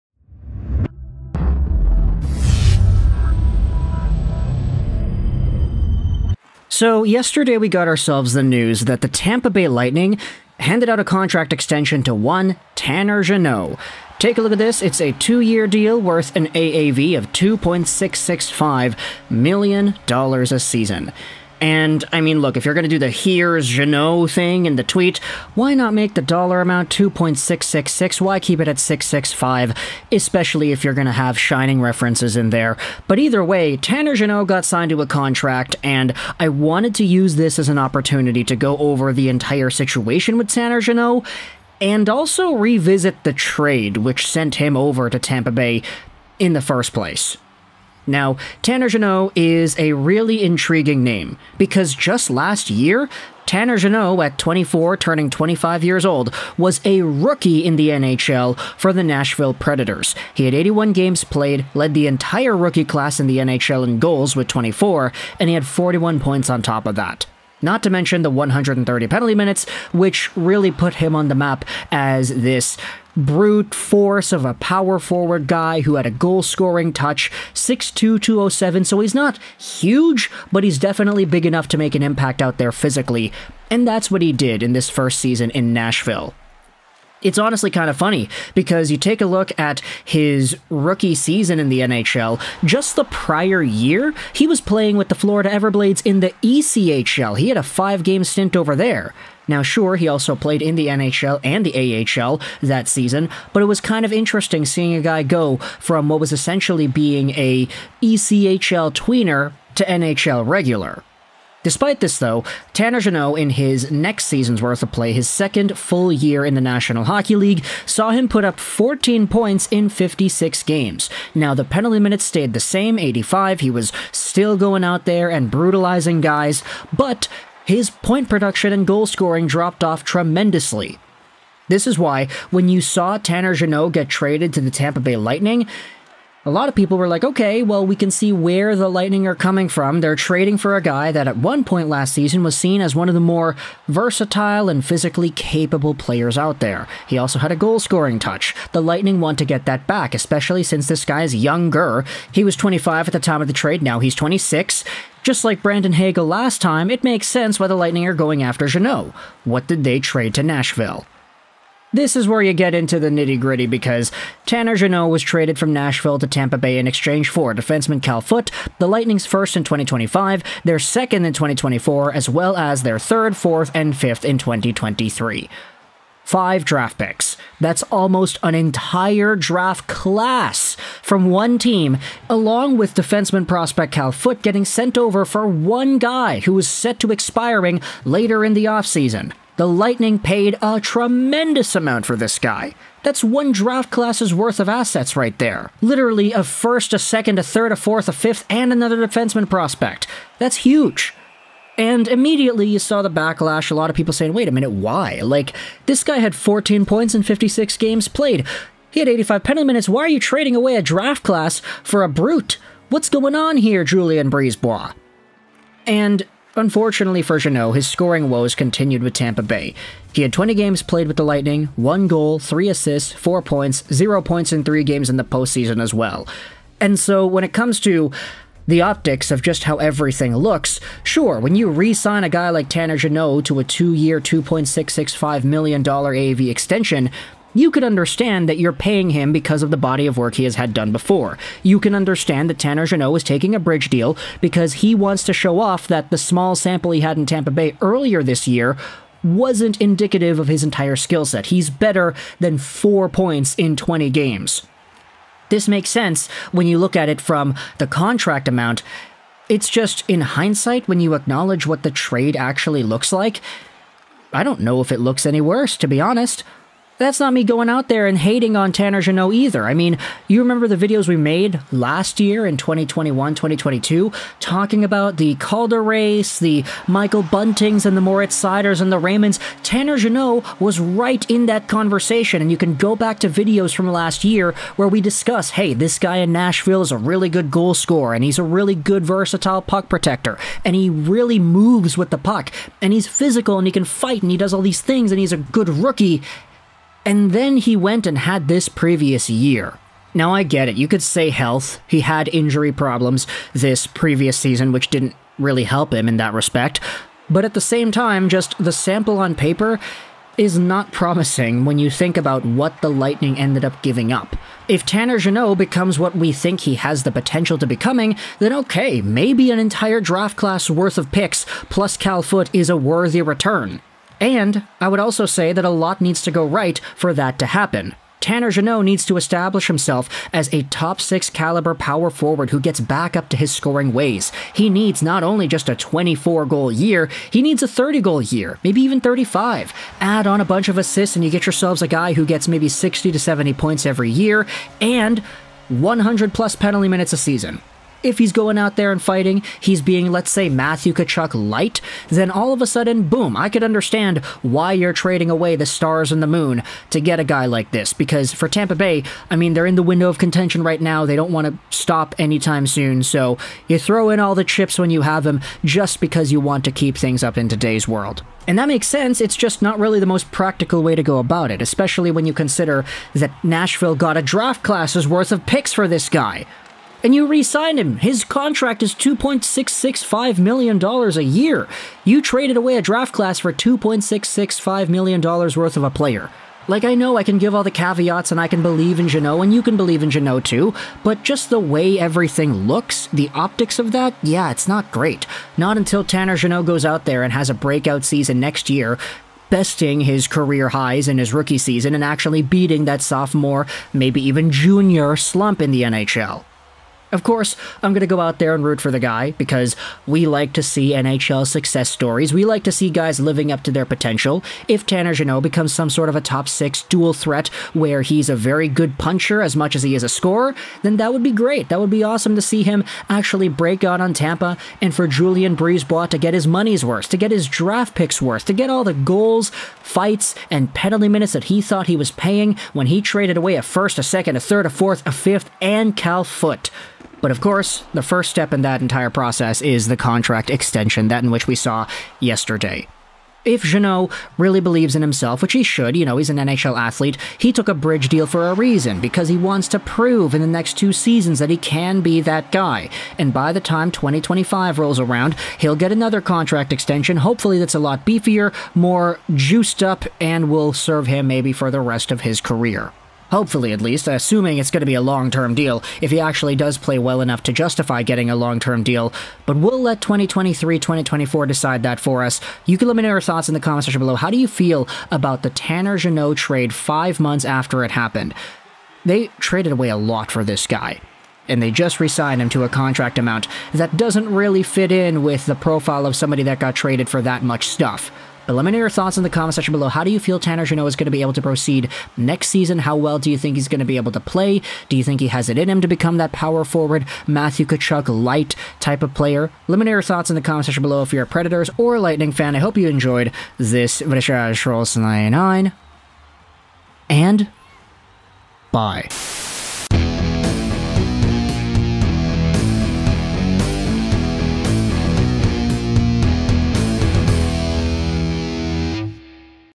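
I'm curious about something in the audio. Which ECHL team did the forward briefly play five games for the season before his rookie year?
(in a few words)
Florida Everblades.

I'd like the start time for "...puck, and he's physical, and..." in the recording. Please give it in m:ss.
4:52.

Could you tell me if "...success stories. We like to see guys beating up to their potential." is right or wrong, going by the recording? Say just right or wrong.
wrong.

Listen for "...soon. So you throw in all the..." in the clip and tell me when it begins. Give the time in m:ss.
6:02.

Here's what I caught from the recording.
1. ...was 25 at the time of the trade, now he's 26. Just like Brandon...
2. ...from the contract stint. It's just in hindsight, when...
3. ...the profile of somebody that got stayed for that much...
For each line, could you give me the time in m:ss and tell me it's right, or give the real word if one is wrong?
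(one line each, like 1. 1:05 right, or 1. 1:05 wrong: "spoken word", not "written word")
1. 2:32 right
2. 4:17 wrong: "amount", not "stint"
3. 8:05 wrong: "traded", not "stayed".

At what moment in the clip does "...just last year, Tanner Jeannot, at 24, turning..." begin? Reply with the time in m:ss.
0:51.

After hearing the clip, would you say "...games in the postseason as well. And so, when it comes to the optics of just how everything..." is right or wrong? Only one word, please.
right.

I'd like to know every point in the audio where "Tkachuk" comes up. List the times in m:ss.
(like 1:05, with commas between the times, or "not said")
5:50, 8:17.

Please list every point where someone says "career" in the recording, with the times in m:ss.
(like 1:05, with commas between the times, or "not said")
6:40, 7:42.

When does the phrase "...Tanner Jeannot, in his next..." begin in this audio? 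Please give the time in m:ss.
1:52.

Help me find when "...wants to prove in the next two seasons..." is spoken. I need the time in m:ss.
7:29.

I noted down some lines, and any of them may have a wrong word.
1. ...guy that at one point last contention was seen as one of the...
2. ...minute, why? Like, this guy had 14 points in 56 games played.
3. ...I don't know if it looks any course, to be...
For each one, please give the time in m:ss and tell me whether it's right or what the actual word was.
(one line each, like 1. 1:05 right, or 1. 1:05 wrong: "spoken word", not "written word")
1. 2:20 wrong: "season", not "contention"
2. 3:24 right
3. 4:24 wrong: "worse", not "course".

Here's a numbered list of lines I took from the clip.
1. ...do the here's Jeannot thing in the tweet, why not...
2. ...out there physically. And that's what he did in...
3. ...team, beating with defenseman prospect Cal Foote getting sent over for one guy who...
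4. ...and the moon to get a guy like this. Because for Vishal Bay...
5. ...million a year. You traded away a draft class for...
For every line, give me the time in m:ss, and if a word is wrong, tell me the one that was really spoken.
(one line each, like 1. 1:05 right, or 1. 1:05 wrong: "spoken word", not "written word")
1. 0:22 right
2. 1:22 right
3. 3:01 wrong: "along", not "beating"
4. 5:56 wrong: "Tampa", not "Vishal"
5. 6:20 right.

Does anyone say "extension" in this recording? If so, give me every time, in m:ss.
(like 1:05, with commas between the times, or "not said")
0:11, 3:56, 7:20, 7:36.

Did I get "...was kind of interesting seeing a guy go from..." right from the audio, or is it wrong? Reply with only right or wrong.
right.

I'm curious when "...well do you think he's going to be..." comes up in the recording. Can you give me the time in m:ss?
8:12.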